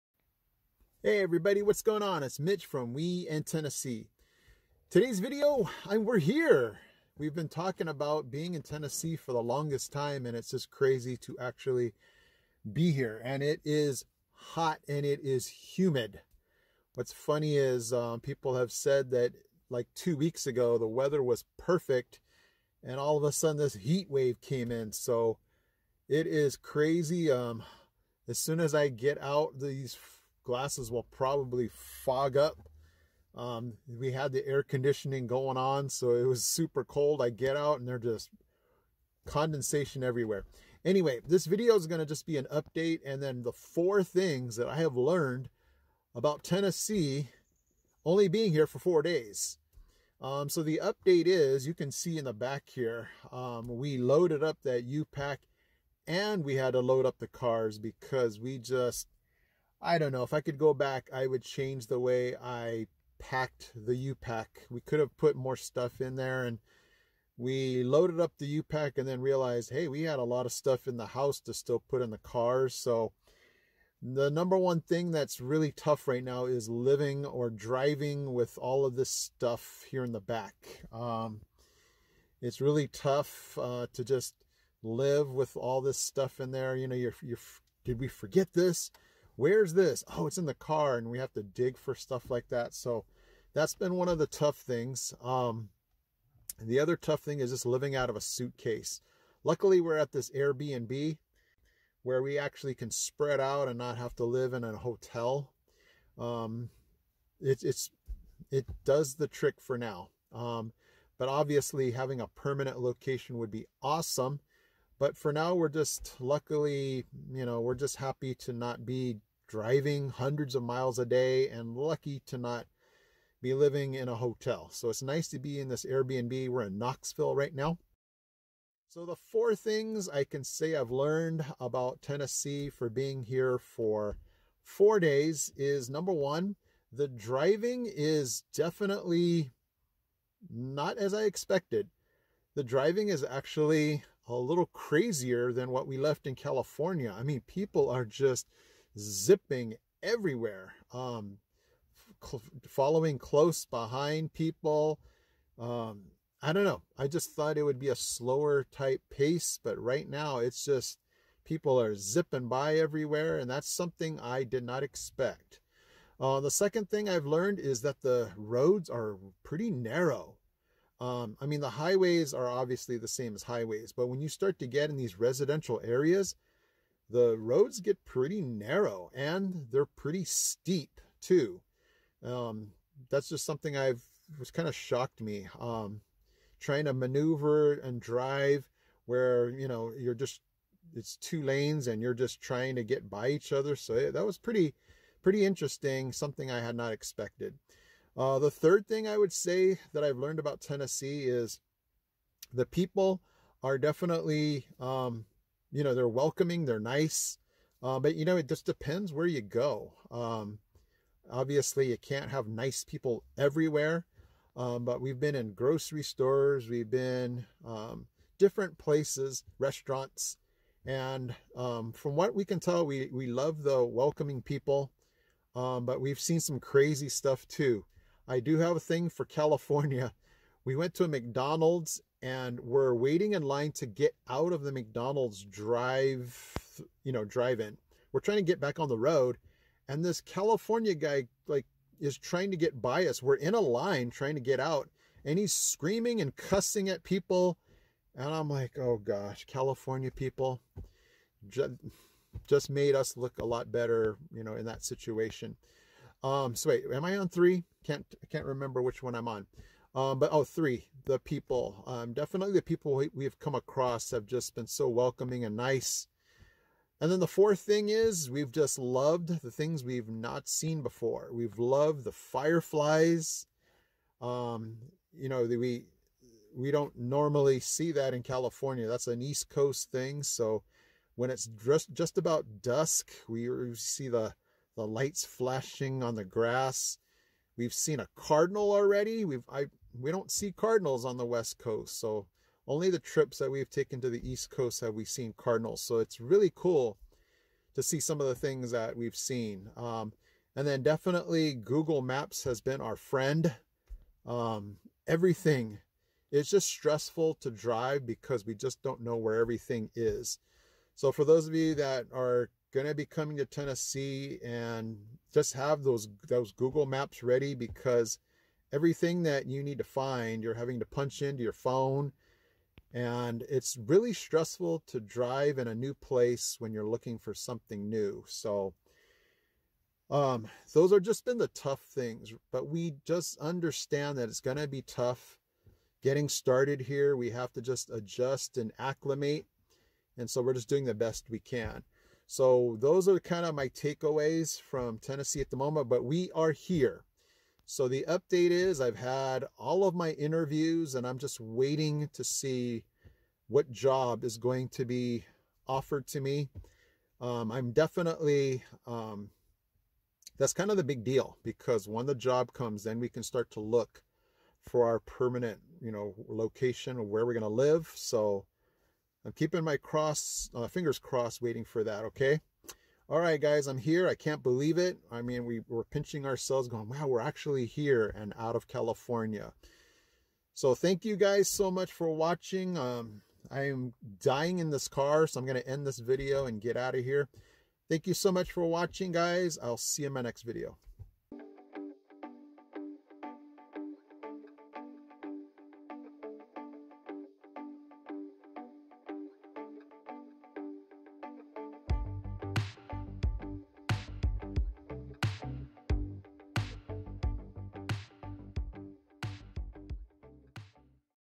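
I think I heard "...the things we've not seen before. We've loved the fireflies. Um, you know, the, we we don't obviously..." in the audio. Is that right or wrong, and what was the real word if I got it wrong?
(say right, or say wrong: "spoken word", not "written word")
wrong: "normally", not "obviously".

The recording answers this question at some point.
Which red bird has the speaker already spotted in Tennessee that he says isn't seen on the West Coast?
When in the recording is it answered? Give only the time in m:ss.
4:48.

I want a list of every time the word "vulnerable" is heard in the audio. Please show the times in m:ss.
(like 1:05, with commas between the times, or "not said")
not said.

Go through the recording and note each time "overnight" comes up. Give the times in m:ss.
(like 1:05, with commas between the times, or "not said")
not said.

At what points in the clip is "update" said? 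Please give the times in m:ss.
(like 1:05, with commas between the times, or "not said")
0:42, 0:50, 5:48.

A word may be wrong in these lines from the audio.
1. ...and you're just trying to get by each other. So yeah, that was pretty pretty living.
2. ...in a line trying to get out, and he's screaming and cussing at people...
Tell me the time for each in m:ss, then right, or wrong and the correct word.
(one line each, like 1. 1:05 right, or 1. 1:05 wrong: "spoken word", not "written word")
1. 3:11 wrong: "interesting", not "living"
2. 4:03 right.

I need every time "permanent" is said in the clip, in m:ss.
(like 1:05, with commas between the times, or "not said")
1:52, 6:05.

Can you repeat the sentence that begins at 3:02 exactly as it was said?
Um, that's just something I've was kind of shocked me.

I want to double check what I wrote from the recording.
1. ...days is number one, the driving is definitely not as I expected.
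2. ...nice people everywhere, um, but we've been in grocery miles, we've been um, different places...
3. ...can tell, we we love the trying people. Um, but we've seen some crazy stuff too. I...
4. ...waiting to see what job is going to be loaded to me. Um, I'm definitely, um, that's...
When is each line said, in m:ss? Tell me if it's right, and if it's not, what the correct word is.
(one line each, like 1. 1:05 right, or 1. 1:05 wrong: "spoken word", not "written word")
1. 2:14 right
2. 3:32 wrong: "stores", not "miles"
3. 3:42 wrong: "welcoming", not "trying"
4. 5:51 wrong: "offered", not "loaded".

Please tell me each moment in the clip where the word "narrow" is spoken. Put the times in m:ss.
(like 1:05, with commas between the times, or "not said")
2:49, 2:58.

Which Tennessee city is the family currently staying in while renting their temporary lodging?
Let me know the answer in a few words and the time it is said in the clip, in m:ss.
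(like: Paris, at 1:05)
Knoxville, at 2:06.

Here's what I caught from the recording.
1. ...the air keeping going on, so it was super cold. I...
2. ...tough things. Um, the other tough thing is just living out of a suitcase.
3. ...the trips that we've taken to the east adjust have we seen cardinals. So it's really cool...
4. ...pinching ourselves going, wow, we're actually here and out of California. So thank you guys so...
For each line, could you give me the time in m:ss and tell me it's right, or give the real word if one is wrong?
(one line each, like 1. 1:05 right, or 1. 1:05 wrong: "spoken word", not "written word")
1. 0:34 wrong: "conditioning", not "keeping"
2. 1:34 right
3. 4:52 wrong: "coast", not "adjust"
4. 6:15 right.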